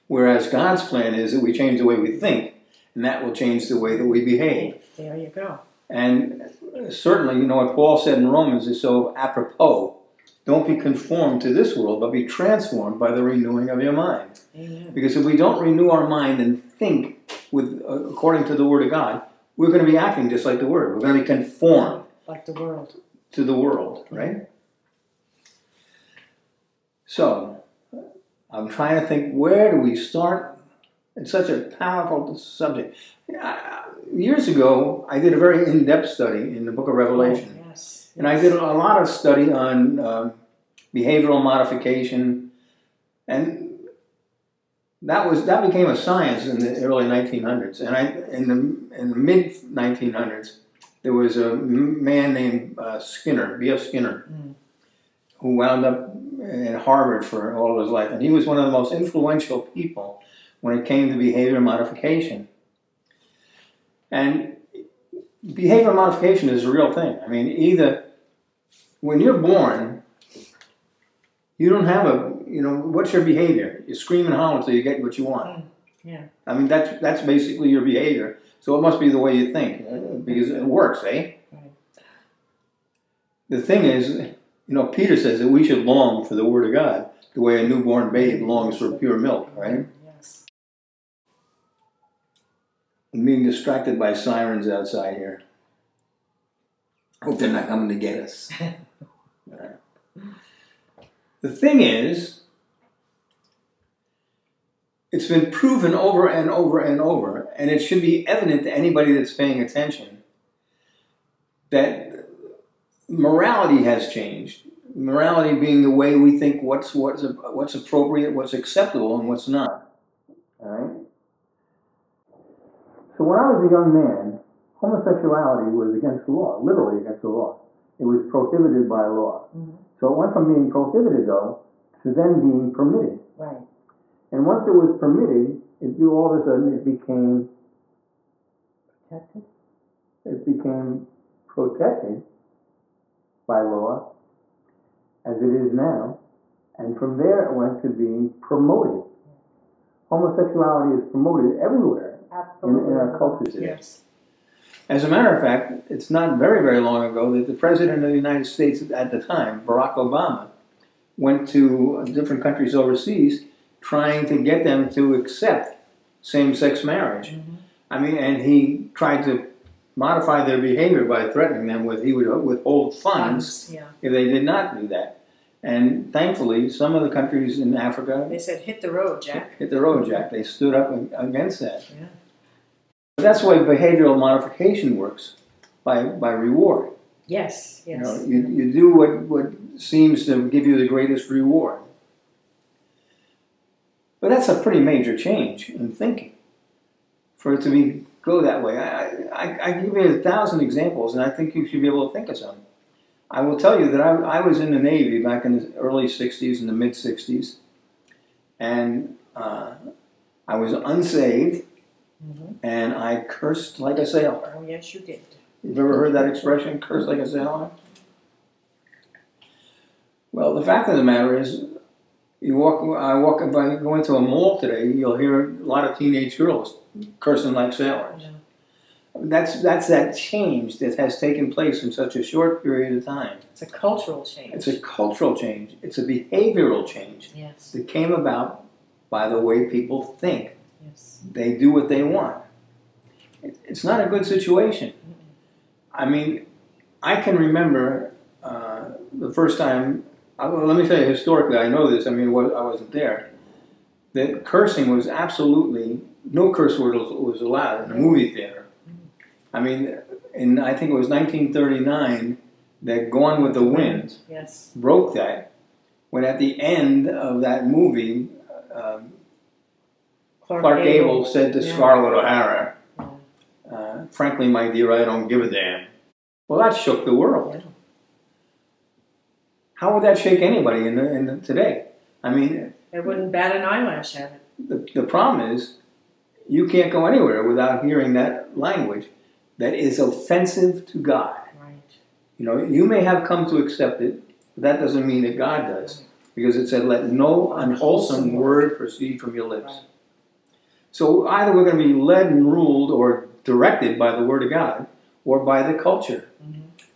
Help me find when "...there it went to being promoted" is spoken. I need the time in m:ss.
2:27.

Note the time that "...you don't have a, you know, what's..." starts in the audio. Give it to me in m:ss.
1:11.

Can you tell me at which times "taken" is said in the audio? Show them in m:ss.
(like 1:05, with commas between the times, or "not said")
3:51.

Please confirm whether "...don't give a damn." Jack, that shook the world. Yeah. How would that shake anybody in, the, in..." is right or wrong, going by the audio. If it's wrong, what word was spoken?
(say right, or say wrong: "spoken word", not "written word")
wrong: "Well", not "Jack".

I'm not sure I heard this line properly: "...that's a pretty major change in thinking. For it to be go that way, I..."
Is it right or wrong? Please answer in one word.
right.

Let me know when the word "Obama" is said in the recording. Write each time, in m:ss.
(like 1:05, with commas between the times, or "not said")
2:39.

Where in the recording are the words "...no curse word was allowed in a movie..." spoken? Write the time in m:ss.
4:16.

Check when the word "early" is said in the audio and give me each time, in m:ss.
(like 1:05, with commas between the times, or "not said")
0:46, 3:25.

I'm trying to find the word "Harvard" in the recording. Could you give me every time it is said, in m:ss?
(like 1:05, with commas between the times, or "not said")
0:56.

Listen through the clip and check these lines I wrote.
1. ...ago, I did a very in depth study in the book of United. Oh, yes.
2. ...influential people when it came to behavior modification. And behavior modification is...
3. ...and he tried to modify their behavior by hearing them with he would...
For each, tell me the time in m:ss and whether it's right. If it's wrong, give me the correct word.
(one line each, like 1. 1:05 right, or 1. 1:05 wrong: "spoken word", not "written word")
1. 0:34 wrong: "Revelation", not "United"
2. 0:58 right
3. 2:48 wrong: "threatening", not "hearing".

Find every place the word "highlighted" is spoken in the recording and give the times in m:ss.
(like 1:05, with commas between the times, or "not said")
not said.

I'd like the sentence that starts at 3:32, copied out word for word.
and I cursed like a sailor.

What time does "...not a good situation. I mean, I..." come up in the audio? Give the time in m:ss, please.
4:03.